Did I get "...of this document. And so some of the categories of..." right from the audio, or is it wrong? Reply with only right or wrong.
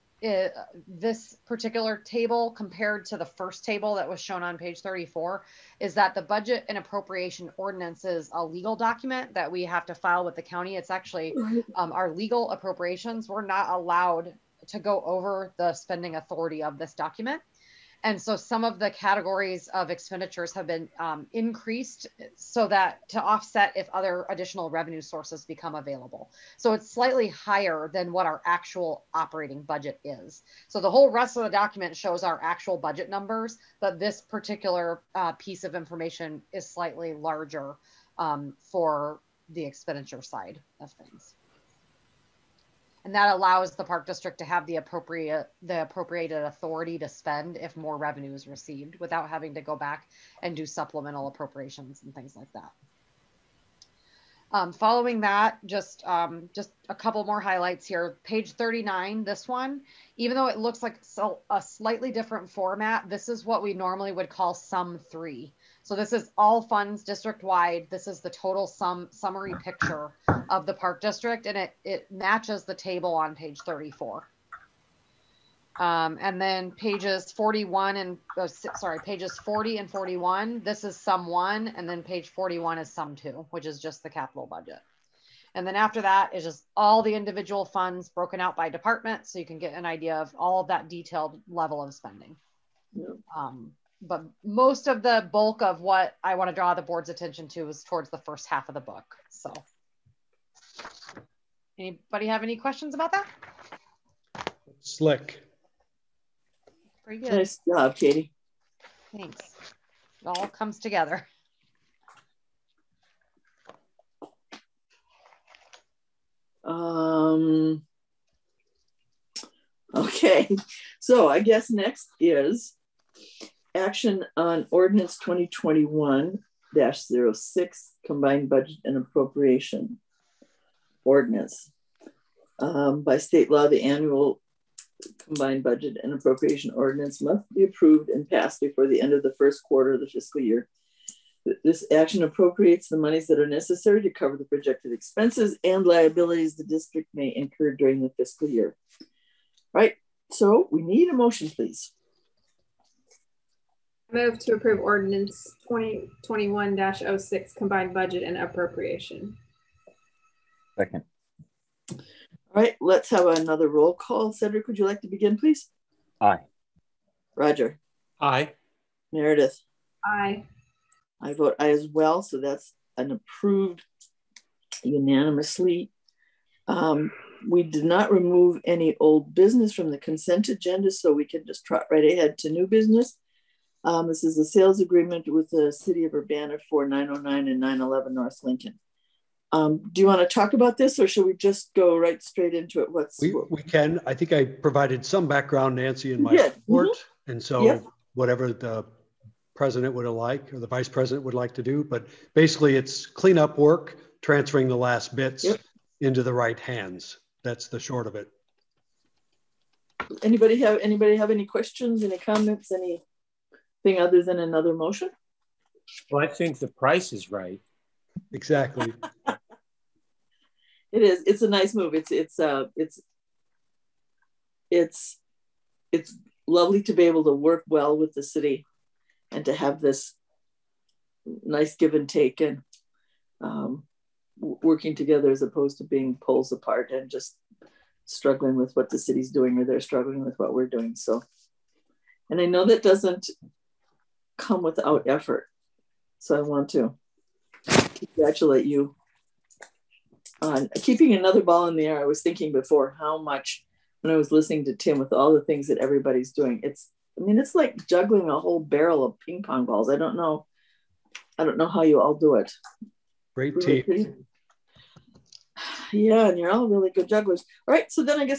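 right.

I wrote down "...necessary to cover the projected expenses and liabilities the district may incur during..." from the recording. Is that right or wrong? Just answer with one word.
right.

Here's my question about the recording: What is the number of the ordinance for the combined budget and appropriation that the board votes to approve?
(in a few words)
2021-06.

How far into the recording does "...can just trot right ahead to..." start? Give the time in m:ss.
3:01.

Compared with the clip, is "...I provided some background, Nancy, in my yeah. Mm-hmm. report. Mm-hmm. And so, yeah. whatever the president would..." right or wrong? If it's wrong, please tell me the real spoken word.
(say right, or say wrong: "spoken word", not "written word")
right.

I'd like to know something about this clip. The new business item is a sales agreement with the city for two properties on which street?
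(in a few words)
North Lincoln.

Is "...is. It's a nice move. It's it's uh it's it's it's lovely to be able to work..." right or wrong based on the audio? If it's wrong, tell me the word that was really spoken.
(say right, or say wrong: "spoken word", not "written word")
right.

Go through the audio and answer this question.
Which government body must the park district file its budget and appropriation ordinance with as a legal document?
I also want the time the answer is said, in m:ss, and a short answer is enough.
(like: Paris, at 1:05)
the county, at 0:10.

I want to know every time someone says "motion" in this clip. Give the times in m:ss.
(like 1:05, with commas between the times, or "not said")
2:31, 3:34.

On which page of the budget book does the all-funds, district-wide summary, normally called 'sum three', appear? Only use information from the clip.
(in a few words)
39.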